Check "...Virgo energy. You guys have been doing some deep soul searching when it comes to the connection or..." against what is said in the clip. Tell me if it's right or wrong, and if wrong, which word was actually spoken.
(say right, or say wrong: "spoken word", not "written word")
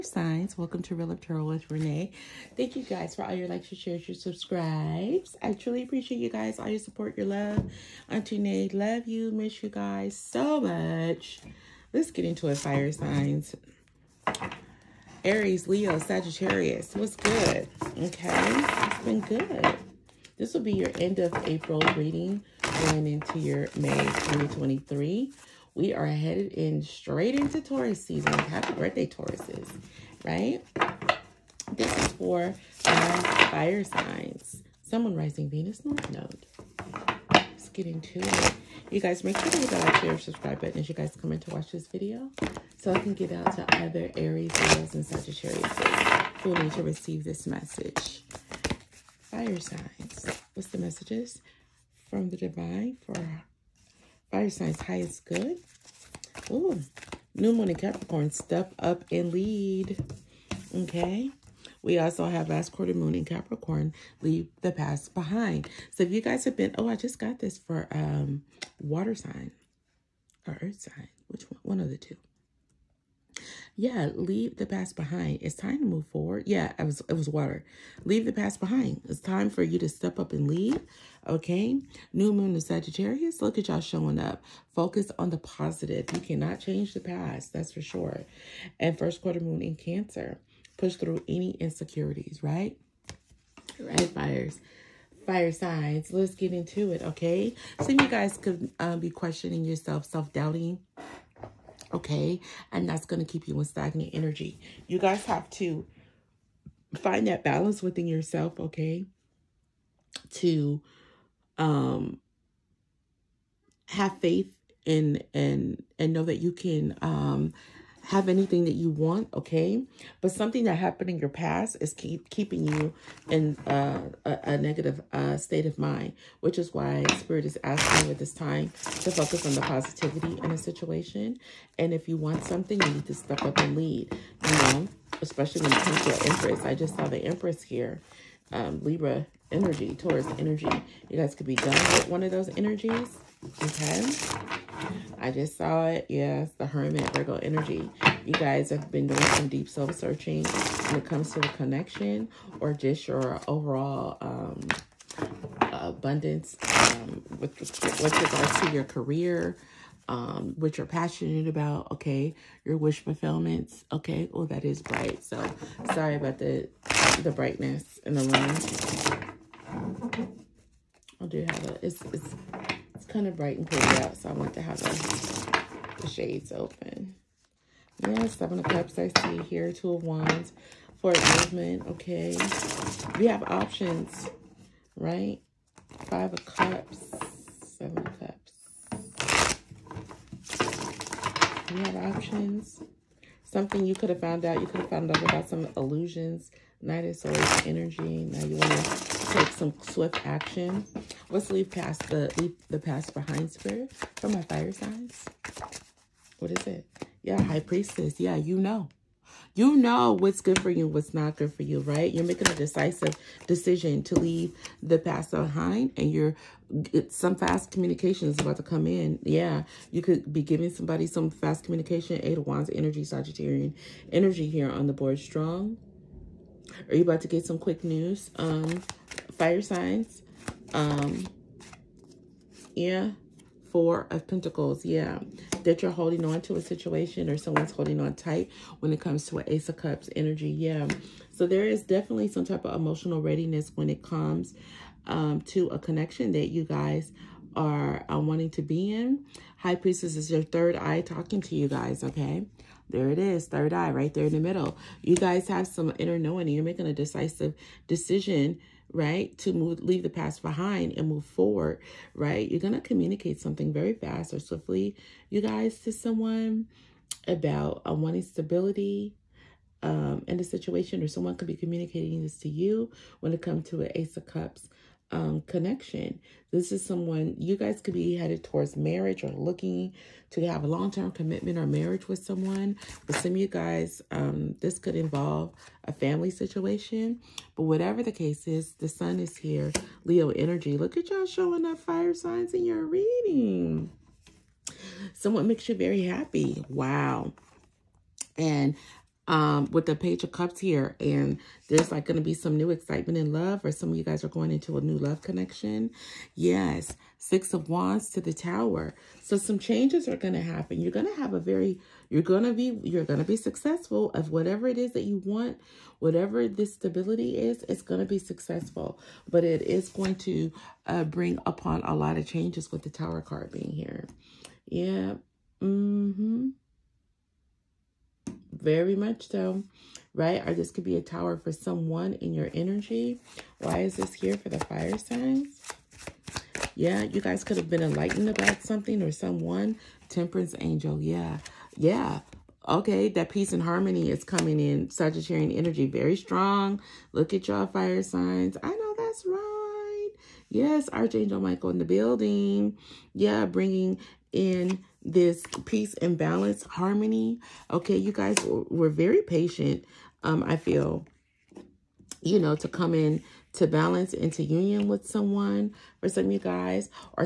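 right.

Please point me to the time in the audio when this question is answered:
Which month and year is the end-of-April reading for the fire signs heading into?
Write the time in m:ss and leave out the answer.
0:23.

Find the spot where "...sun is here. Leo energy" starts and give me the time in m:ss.
4:48.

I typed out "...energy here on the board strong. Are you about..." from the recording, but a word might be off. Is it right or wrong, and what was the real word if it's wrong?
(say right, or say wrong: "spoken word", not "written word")
right.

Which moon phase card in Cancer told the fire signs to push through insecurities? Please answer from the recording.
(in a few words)
First quarter moon.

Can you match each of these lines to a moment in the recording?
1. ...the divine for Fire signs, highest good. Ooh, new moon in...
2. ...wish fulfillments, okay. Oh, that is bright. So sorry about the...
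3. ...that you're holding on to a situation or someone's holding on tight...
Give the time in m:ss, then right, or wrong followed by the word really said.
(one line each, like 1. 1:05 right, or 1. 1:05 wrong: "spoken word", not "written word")
1. 0:52 right
2. 2:42 right
3. 3:55 right.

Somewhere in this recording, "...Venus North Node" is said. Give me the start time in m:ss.
0:35.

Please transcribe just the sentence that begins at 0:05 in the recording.
I truly appreciate you guys, all your support, your love.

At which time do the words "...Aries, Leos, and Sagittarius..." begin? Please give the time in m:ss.
0:44.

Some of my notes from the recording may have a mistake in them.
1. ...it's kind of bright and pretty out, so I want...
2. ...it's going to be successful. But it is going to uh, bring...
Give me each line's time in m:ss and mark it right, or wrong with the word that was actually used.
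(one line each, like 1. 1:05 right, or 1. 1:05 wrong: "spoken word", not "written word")
1. 2:52 right
2. 5:17 right.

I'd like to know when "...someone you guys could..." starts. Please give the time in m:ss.
4:36.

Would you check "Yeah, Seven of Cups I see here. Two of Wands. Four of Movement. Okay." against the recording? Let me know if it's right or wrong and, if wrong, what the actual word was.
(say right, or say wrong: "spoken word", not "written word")
right.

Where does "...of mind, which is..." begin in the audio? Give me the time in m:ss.
2:05.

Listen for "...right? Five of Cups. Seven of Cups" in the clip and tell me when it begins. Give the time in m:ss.
3:04.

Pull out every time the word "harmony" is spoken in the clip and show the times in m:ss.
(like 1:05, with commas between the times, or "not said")
5:43, 5:56.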